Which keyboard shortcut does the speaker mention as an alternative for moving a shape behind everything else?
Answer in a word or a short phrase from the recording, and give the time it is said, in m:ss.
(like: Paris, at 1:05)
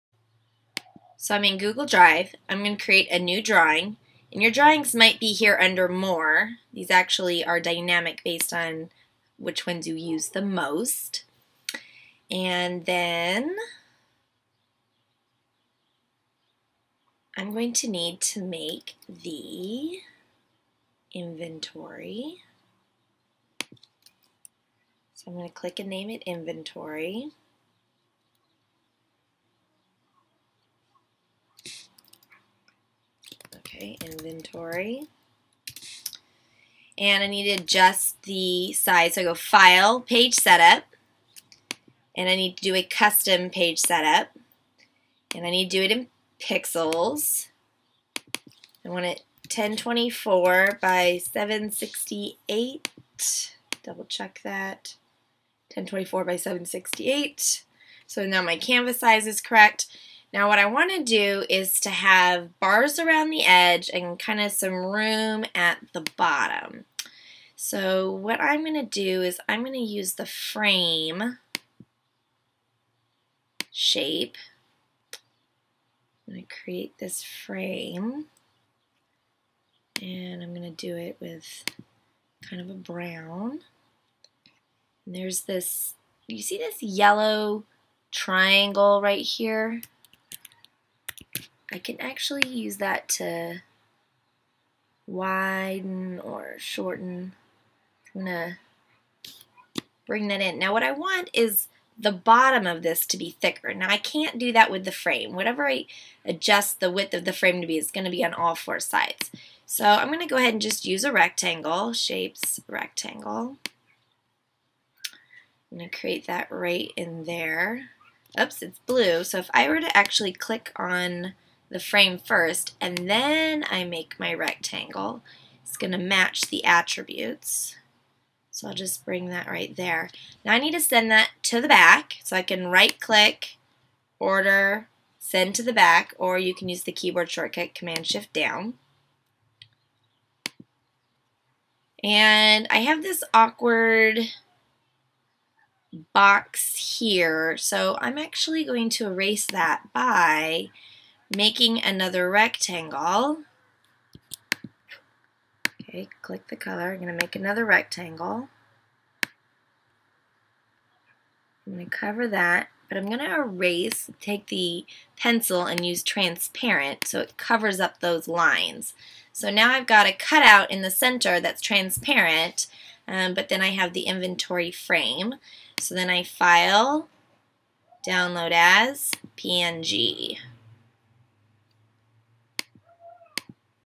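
Command-Shift-Down, at 2:17.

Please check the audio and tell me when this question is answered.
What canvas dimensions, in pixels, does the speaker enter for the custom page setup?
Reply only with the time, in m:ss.
0:49.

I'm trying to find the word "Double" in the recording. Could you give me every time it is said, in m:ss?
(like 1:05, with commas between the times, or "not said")
0:53.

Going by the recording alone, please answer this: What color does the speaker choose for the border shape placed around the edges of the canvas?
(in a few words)
brown.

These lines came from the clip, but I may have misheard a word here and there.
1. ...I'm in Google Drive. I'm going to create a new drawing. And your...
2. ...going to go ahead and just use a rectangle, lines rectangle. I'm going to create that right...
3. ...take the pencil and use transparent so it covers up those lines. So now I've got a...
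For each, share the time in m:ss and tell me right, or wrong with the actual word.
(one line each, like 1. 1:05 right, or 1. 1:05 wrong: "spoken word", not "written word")
1. 0:01 right
2. 1:50 wrong: "shapes", not "lines"
3. 2:44 right.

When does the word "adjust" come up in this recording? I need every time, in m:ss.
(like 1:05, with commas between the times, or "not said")
0:37, 1:46.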